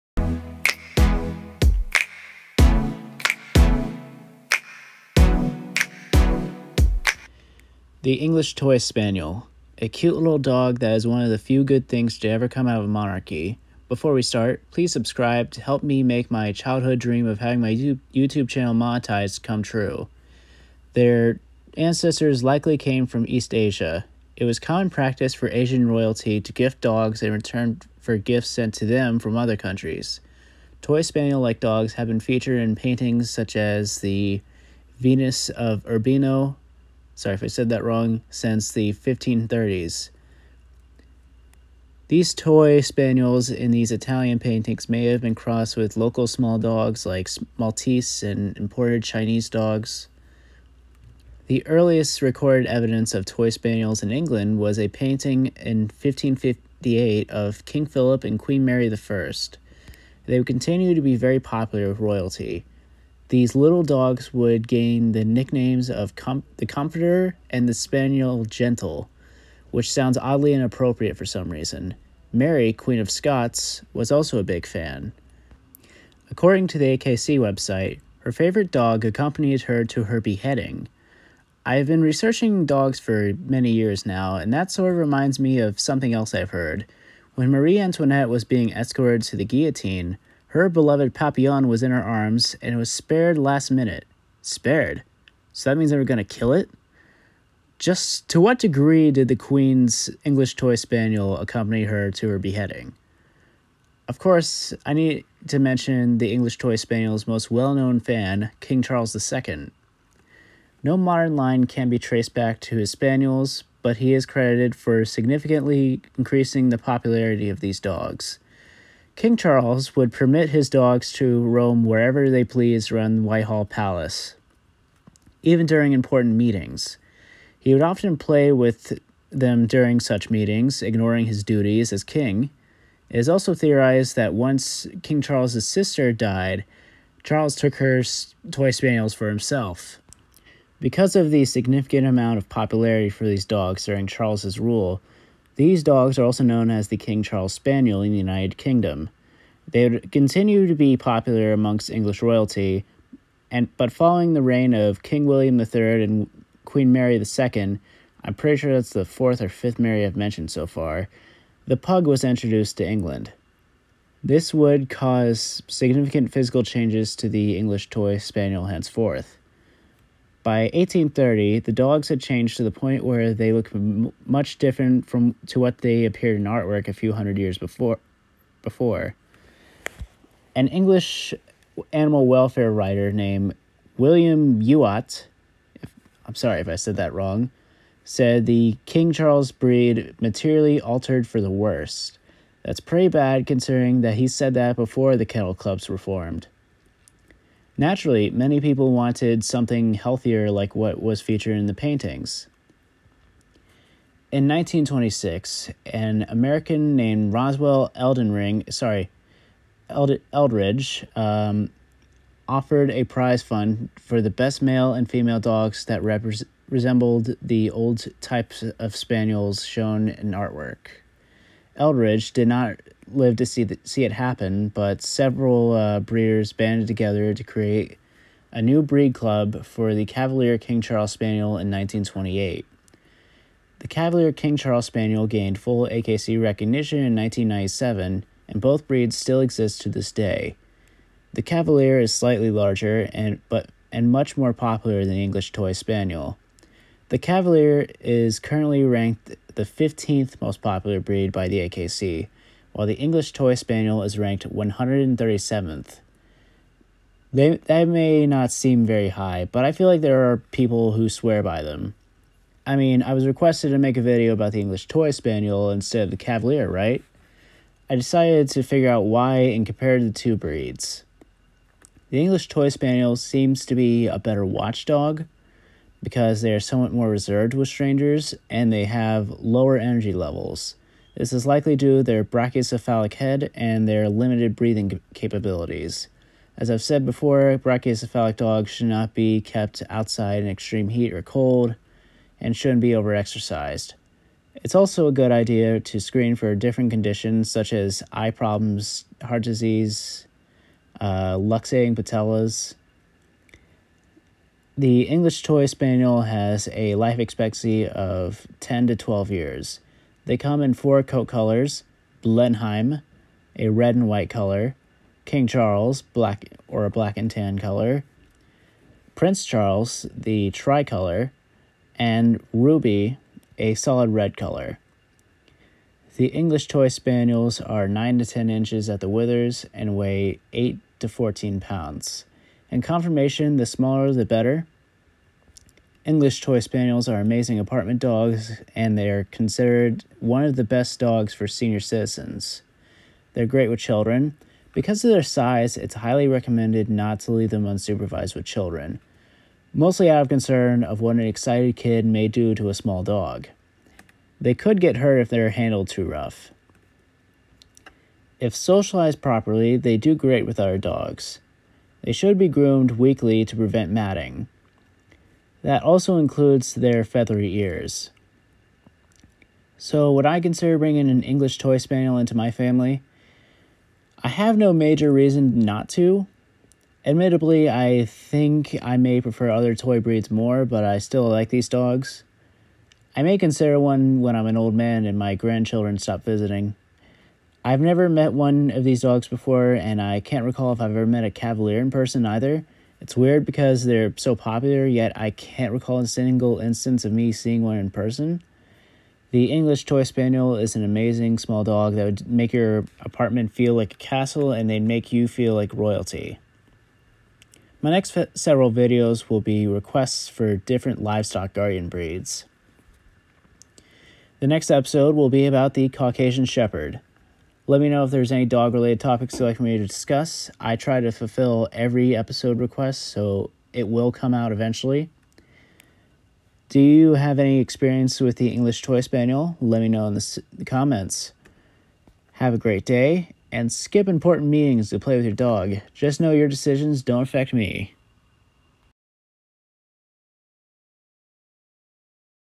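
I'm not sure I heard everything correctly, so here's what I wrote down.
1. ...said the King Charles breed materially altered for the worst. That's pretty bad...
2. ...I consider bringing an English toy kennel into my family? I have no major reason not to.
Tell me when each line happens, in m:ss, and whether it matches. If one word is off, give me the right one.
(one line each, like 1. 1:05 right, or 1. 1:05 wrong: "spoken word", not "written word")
1. 3:08 right
2. 6:10 wrong: "spaniel", not "kennel".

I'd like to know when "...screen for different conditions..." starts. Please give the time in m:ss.
4:55.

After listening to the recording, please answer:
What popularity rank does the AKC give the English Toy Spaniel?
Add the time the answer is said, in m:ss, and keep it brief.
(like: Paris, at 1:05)
137th, at 4:14.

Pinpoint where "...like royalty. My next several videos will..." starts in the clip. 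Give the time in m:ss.
6:45.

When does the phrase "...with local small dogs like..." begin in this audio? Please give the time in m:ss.
0:45.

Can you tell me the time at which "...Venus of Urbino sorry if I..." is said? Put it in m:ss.
0:34.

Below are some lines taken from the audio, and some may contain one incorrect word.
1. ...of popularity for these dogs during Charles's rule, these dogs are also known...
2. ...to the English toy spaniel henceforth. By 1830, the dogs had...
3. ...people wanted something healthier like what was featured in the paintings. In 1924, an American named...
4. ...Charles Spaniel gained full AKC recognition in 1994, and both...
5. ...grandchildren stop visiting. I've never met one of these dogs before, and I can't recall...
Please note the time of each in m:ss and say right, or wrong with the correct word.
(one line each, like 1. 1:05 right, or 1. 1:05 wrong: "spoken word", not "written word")
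1. 2:22 right
2. 2:47 right
3. 3:18 wrong: "1926", not "1924"
4. 3:54 wrong: "1997", not "1994"
5. 6:25 right.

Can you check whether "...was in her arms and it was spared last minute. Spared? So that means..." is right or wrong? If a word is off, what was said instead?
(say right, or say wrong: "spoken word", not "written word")
right.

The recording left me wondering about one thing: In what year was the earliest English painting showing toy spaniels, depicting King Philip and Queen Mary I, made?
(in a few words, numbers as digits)
1558.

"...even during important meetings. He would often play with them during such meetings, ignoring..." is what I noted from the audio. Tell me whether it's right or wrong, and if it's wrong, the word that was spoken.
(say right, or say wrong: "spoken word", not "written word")
right.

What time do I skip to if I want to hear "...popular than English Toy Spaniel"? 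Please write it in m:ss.
4:04.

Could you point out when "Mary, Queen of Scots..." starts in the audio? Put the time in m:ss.
1:12.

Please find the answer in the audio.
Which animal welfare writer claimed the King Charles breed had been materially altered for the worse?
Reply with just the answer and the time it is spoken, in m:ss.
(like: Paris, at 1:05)
William Youatt, at 3:03.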